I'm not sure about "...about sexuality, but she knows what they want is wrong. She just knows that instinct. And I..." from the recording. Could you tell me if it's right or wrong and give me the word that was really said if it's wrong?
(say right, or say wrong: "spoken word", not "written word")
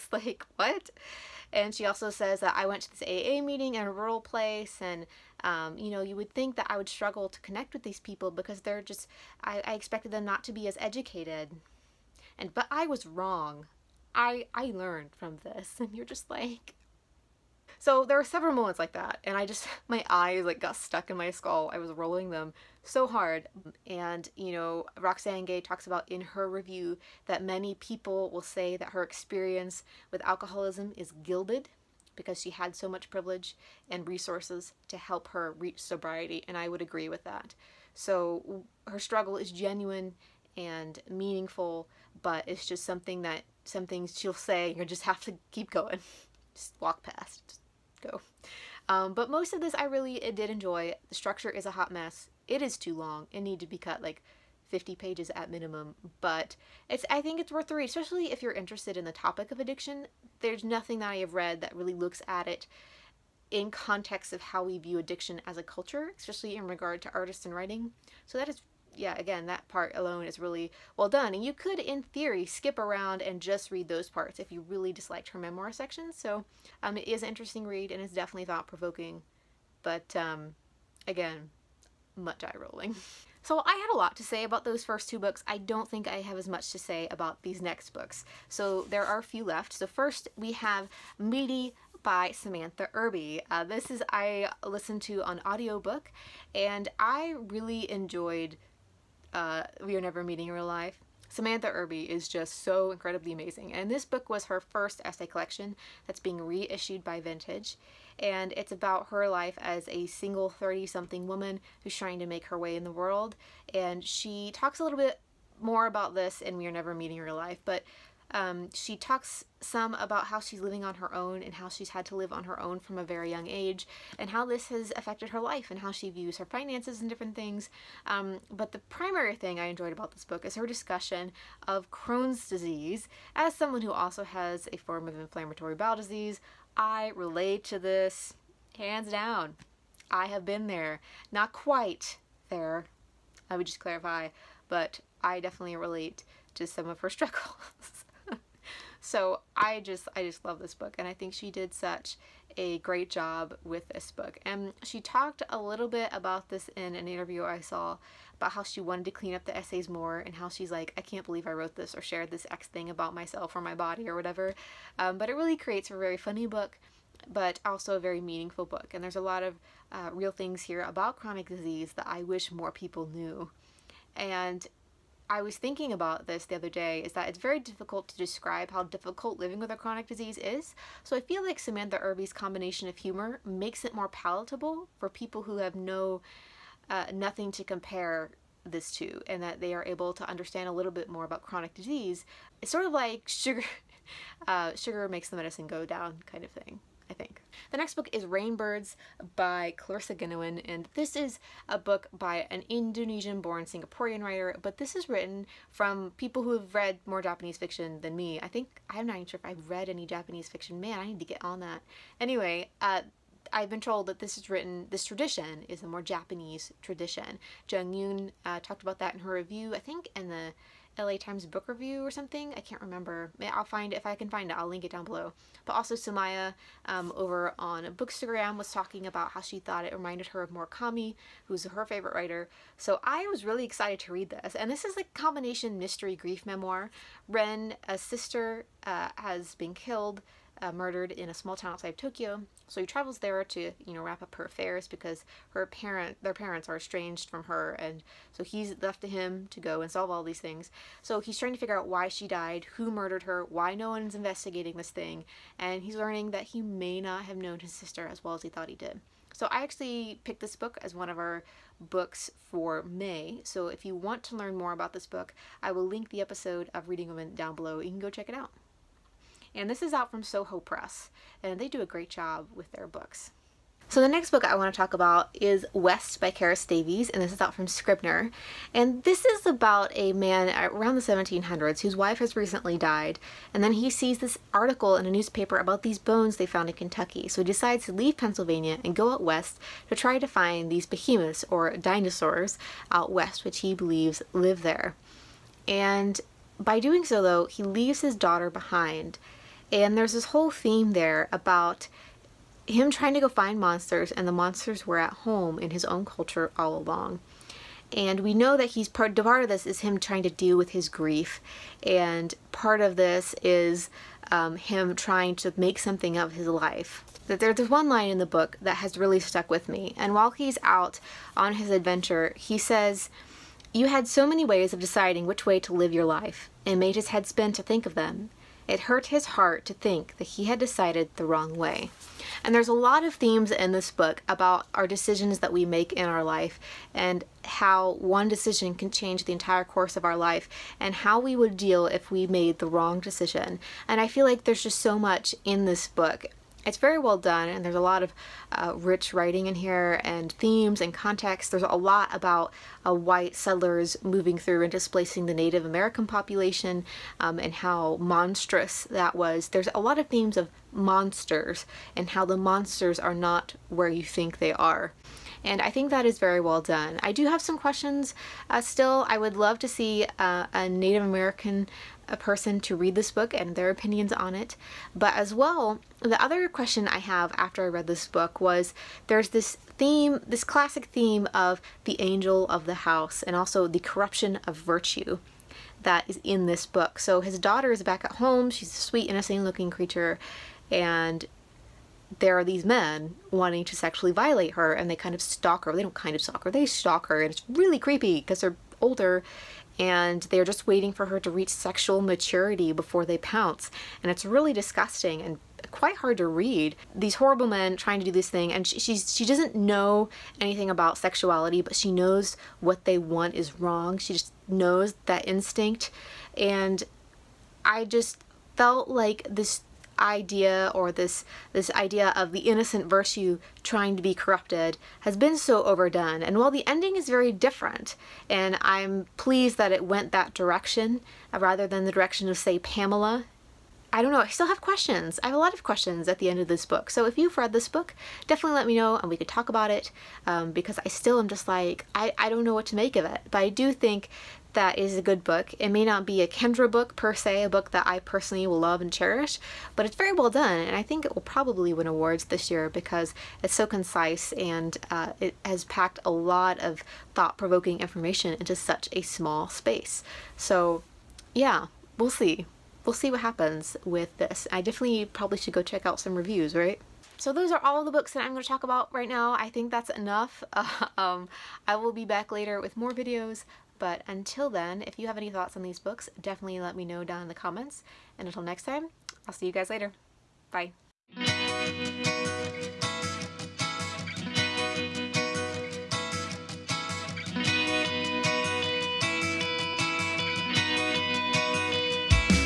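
right.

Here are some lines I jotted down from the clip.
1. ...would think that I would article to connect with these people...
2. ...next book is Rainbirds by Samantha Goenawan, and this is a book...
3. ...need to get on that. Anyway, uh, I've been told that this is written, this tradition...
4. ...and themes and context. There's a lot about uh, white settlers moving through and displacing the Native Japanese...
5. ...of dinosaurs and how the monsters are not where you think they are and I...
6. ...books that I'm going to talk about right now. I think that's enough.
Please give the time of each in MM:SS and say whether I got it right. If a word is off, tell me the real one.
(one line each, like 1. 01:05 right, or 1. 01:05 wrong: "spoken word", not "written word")
1. 00:06 wrong: "struggle", not "article"
2. 03:17 wrong: "Clarissa", not "Samantha"
3. 03:31 right
4. 05:50 wrong: "American", not "Japanese"
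5. 06:00 wrong: "monsters", not "dinosaurs"
6. 07:47 right.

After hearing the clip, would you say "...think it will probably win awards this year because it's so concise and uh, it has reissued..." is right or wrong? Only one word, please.
wrong.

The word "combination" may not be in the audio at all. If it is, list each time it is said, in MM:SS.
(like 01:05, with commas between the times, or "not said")
03:02, 03:55.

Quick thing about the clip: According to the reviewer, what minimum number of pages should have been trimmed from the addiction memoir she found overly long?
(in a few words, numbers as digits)
50.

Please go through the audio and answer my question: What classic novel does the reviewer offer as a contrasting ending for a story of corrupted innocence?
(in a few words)
Pamela.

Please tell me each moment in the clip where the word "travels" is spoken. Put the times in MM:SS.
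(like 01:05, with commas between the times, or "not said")
04:02.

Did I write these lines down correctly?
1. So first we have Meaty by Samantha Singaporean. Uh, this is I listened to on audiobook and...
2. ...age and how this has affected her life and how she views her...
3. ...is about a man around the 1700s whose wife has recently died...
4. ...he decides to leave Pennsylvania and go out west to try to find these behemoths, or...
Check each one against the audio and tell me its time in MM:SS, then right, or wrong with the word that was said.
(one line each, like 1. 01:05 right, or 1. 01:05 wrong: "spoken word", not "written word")
1. 01:29 wrong: "Irby", not "Singaporean"
2. 02:03 right
3. 04:39 right
4. 04:47 right.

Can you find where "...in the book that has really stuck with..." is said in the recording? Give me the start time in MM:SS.
05:18.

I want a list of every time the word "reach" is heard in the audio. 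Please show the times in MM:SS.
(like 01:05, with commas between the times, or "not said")
00:35, 06:41.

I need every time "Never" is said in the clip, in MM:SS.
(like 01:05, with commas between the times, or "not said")
01:40, 01:56.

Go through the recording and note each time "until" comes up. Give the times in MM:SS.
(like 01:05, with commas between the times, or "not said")
07:54, 07:58.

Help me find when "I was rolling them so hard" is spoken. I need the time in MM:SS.
00:21.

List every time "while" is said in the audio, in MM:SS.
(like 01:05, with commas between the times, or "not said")
05:20, 07:06.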